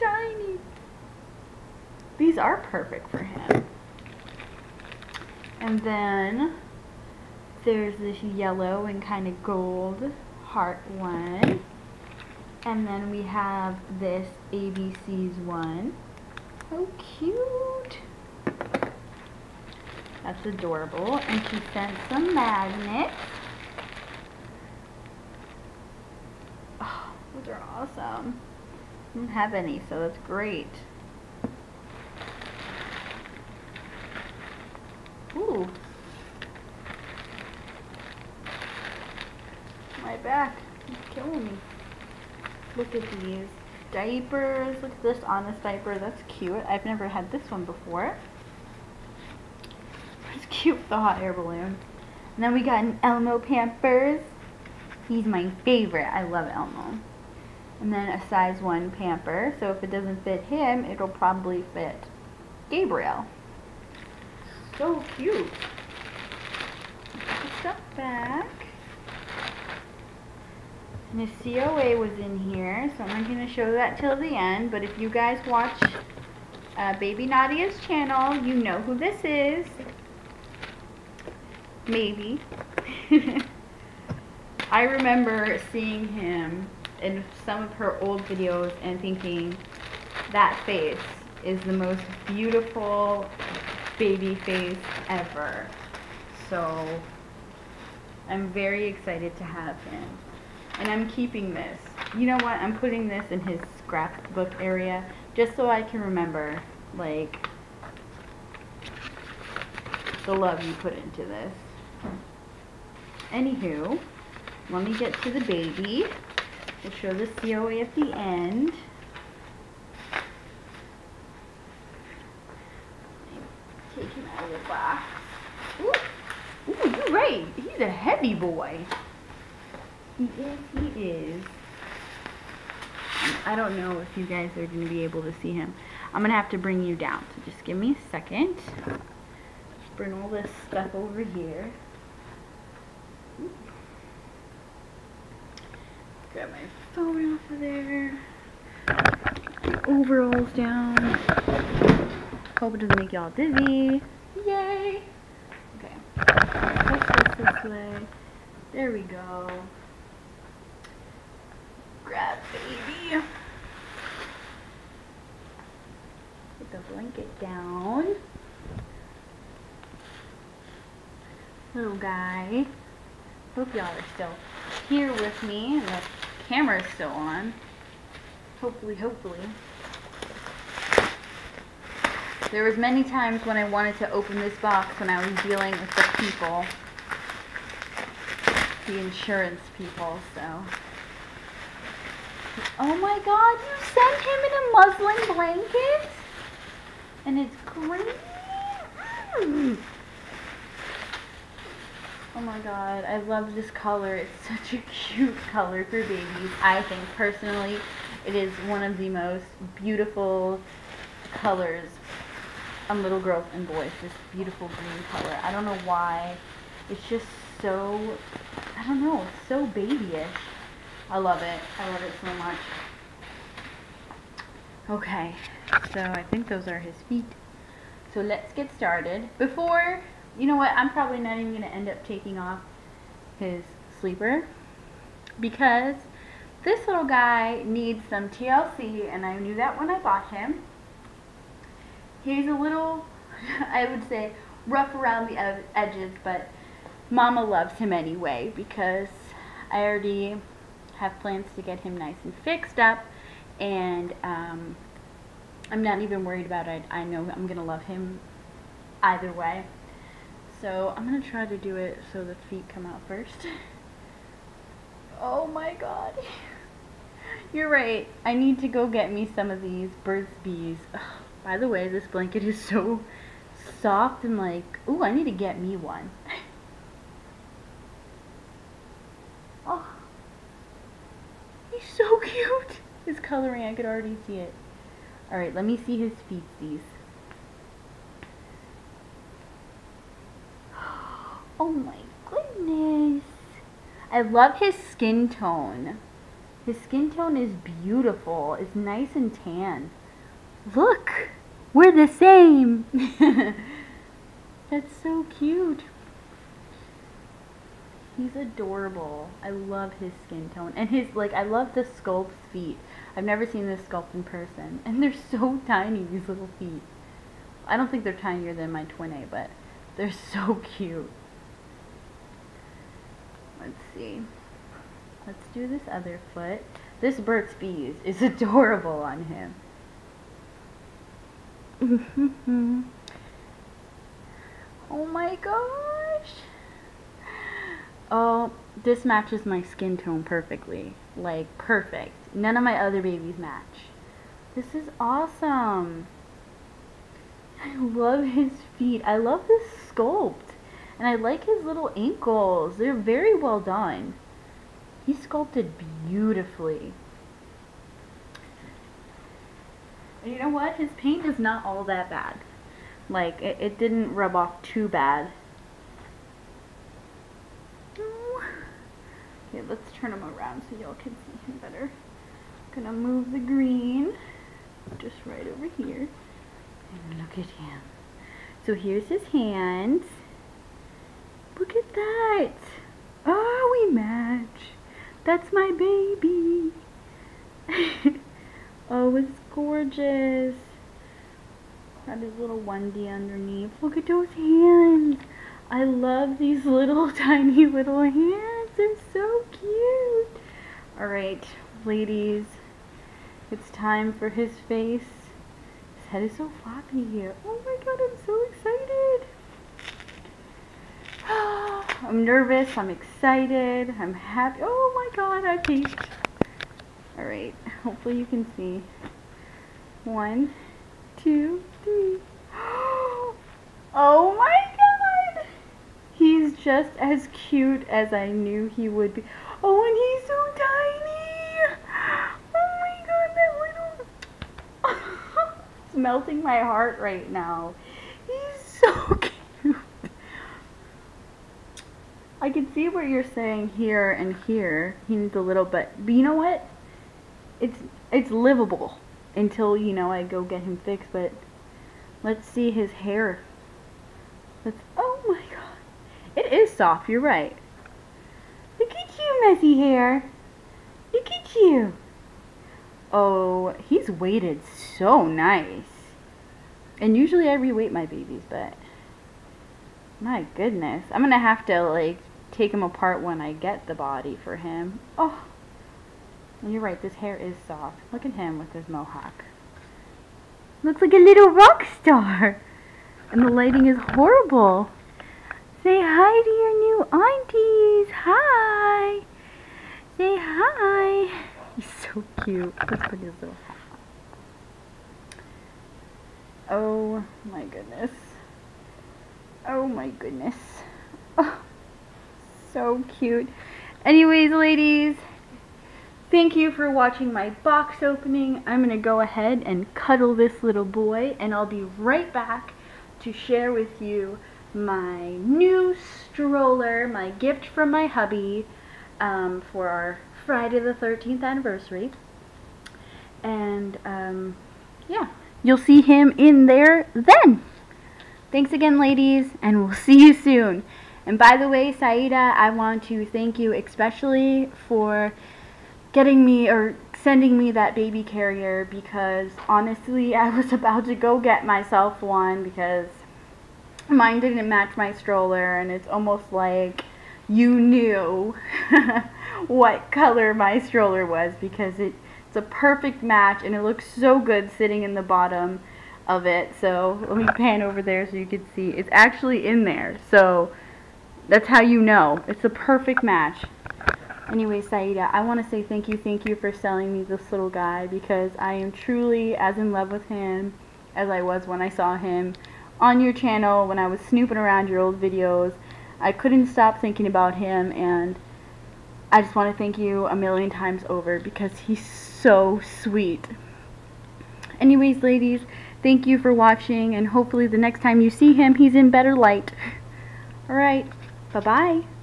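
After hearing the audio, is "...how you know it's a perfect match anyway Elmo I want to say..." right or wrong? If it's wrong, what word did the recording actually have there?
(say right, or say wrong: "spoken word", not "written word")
wrong: "Saida", not "Elmo".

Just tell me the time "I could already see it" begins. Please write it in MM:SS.
04:43.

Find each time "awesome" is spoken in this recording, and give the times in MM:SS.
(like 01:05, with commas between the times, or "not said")
00:27, 05:44.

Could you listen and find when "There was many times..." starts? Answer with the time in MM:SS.
03:02.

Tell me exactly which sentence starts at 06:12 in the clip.
I'm gonna move the green just right over here.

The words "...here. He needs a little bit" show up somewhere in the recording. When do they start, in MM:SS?
07:24.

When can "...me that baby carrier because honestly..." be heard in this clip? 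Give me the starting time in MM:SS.
08:57.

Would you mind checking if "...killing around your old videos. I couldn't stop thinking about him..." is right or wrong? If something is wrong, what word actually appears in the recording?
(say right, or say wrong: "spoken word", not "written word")
wrong: "snooping", not "killing".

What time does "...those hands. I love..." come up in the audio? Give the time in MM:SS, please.
06:34.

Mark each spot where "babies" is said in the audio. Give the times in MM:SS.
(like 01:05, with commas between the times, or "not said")
03:26, 05:43, 07:48.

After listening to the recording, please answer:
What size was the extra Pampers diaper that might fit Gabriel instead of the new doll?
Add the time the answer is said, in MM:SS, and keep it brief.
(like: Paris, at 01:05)
1, at 00:58.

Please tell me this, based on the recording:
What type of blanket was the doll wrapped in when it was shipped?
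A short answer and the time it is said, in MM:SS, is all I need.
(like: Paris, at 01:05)
Muslin, at 03:15.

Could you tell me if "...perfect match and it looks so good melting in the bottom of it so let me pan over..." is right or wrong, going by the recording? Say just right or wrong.
wrong.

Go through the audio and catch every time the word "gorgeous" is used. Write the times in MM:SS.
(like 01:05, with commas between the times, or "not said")
06:29.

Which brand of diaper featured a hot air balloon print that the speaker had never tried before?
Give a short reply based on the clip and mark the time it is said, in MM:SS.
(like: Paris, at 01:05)
Honest, at 00:45.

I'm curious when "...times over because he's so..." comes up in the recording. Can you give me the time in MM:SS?
09:40.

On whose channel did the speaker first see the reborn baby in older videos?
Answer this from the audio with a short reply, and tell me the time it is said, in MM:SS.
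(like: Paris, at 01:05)
Baby Nadia's, at 01:16.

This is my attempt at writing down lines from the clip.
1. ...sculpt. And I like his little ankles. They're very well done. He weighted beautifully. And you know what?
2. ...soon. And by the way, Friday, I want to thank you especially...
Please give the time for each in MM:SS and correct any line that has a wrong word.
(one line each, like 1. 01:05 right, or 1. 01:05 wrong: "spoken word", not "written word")
1. 05:49 wrong: "sculpted", not "weighted"
2. 08:50 wrong: "Saida", not "Friday".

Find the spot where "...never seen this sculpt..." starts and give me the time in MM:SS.
05:13.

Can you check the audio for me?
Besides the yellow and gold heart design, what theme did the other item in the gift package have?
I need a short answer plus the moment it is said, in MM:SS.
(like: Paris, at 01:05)
ABC's, at 00:14.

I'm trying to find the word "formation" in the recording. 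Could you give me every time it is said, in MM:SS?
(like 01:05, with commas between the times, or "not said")
not said.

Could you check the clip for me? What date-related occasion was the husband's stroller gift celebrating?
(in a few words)
Friday the 13th anniversary.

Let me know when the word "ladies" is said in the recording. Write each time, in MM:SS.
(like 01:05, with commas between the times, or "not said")
06:41, 08:24, 08:48, 09:45.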